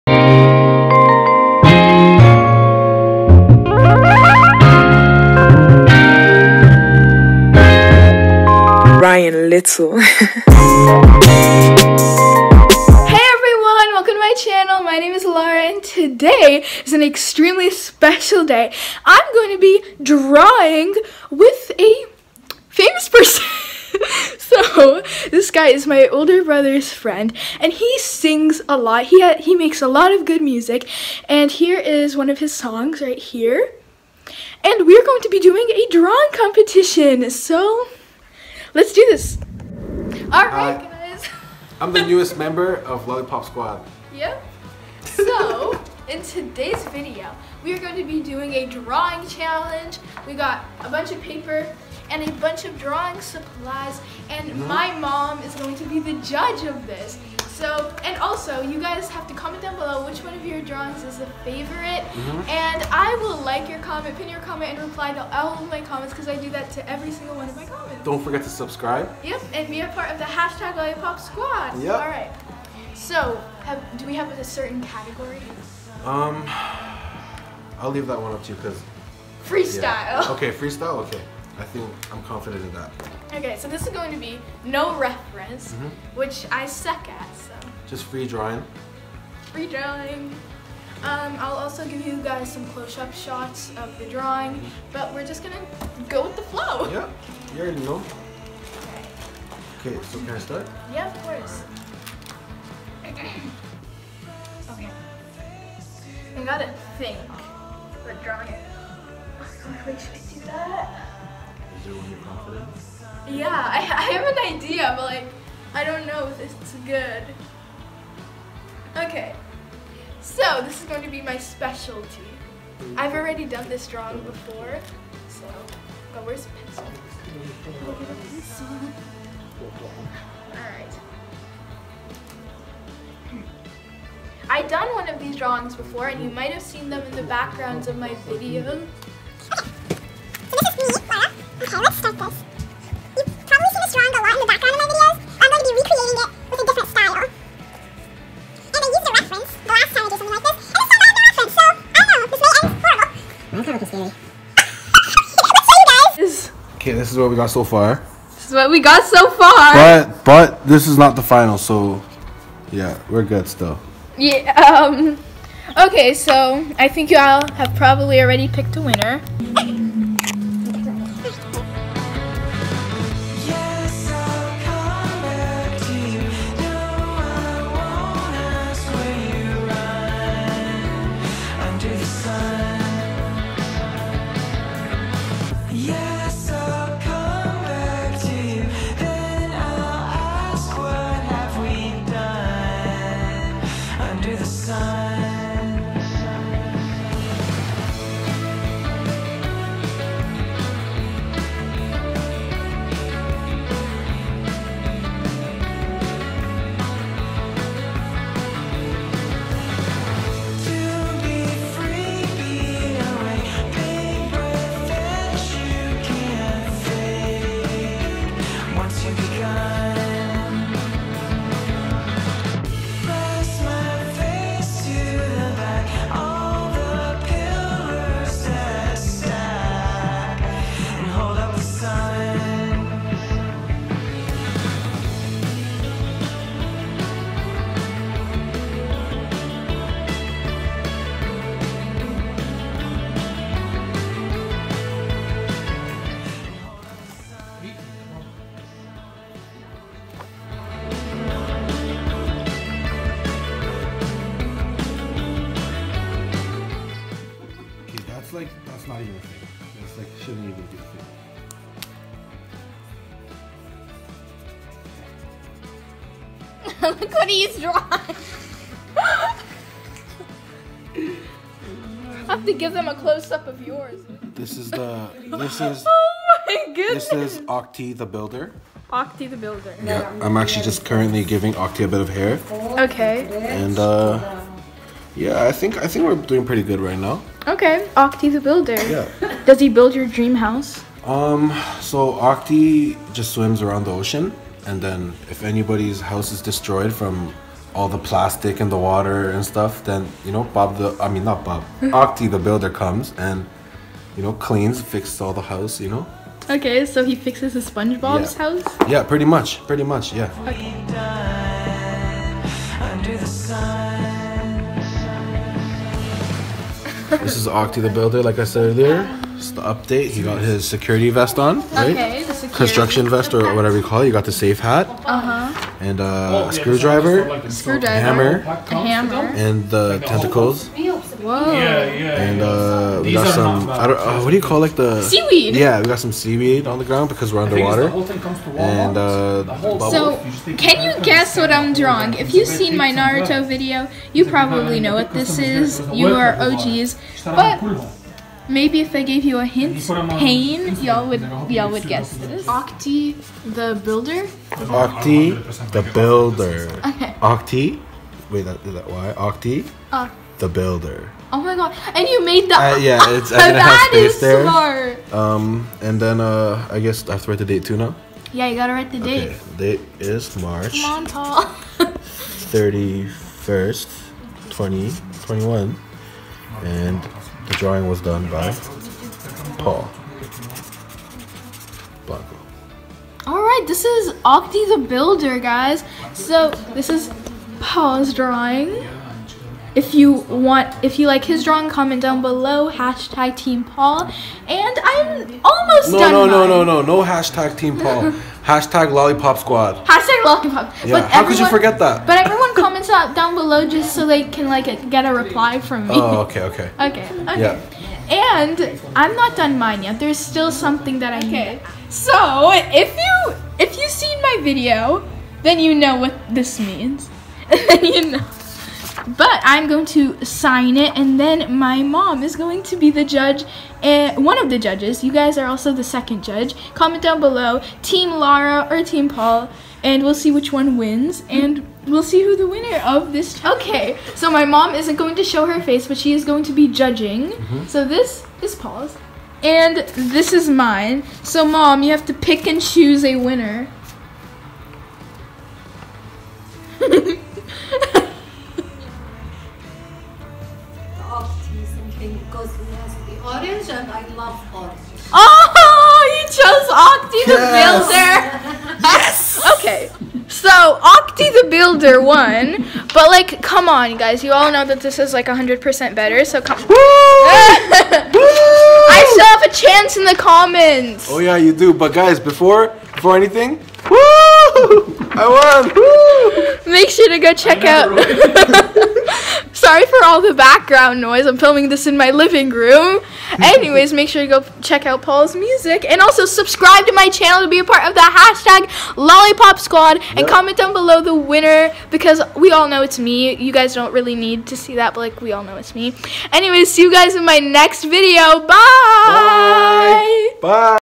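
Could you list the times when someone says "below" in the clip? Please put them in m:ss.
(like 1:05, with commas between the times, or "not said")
0:59, 6:32, 6:43, 7:07, 8:10.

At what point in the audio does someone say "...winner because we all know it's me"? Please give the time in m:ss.
8:11.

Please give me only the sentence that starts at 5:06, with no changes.
Okay, so he fixes a SpongeBob's yeah.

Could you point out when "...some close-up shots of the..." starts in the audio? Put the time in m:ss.
1:32.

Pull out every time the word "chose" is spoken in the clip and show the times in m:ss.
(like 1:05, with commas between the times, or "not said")
7:36.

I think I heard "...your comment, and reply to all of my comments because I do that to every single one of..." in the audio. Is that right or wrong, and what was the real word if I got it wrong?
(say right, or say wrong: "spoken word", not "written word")
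right.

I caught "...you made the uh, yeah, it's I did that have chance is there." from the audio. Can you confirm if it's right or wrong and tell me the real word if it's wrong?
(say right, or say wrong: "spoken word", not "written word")
wrong: "space", not "chance".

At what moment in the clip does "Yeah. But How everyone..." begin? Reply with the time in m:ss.
6:40.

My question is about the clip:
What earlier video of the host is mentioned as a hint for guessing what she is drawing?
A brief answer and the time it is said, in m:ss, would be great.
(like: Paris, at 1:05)
Naruto video, at 5:42.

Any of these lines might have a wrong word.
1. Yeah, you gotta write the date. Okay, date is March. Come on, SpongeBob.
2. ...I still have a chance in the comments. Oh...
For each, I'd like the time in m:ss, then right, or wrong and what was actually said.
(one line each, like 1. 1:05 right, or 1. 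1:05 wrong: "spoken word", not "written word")
1. 6:08 wrong: "Paul", not "SpongeBob"
2. 7:48 right.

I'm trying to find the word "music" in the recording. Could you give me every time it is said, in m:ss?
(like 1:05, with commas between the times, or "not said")
0:30, 8:05.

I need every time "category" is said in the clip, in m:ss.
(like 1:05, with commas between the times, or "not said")
1:14.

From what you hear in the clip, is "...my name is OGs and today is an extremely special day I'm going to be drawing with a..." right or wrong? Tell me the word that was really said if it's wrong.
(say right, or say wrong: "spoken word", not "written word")
wrong: "Lara", not "OGs".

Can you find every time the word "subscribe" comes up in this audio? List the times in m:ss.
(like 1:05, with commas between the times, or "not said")
1:08, 8:06.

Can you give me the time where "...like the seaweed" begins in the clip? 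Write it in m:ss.
5:34.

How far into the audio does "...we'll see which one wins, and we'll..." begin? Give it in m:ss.
7:10.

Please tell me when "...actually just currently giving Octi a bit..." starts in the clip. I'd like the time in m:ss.
4:40.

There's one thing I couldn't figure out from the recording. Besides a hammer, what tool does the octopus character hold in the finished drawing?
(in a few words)
screwdriver.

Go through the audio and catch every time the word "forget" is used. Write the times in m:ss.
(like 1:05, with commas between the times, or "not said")
1:08, 6:41.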